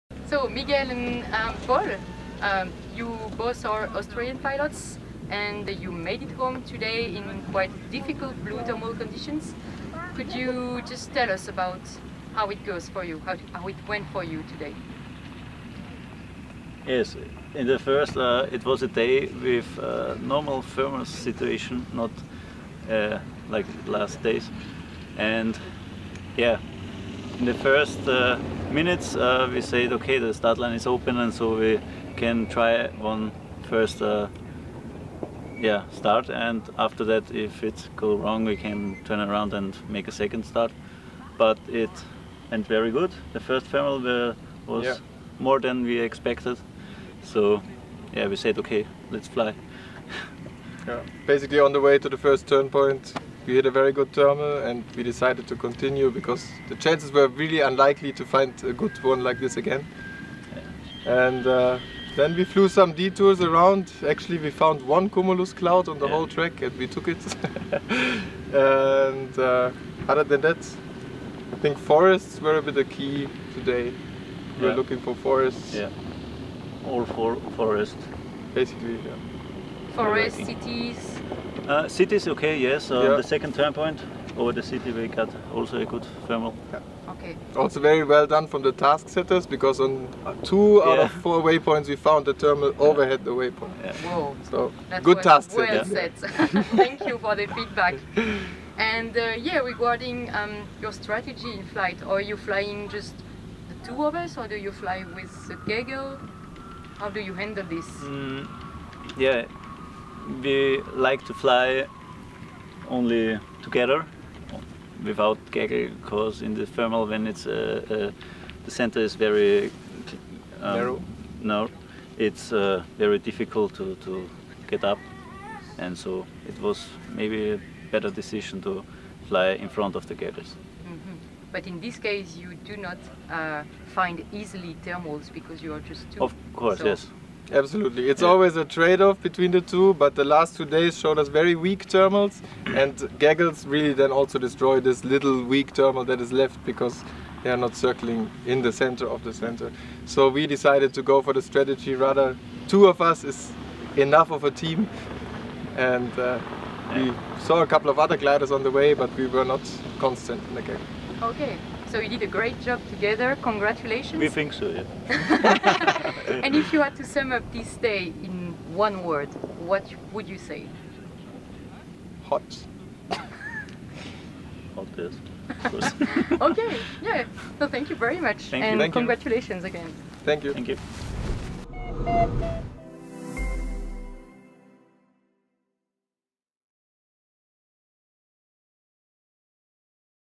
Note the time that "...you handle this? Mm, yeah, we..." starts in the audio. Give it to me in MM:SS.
01:47.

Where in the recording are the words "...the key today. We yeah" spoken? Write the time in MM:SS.
01:12.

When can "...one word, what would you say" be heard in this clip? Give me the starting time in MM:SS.
02:48.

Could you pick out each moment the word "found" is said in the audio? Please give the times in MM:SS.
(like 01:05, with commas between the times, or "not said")
01:04, 01:31.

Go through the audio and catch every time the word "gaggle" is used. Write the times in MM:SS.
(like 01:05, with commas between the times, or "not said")
01:45, 01:55, 02:23.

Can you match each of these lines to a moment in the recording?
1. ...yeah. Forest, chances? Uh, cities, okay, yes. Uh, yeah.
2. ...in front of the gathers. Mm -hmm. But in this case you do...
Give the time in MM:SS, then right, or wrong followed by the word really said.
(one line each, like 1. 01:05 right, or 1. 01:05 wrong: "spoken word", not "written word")
1. 01:18 wrong: "cities", not "chances"
2. 02:09 right.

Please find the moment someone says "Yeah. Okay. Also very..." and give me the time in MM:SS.
01:26.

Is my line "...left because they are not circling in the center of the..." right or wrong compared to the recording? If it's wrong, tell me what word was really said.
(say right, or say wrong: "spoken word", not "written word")
right.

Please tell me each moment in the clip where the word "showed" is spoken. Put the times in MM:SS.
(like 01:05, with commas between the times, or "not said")
02:20.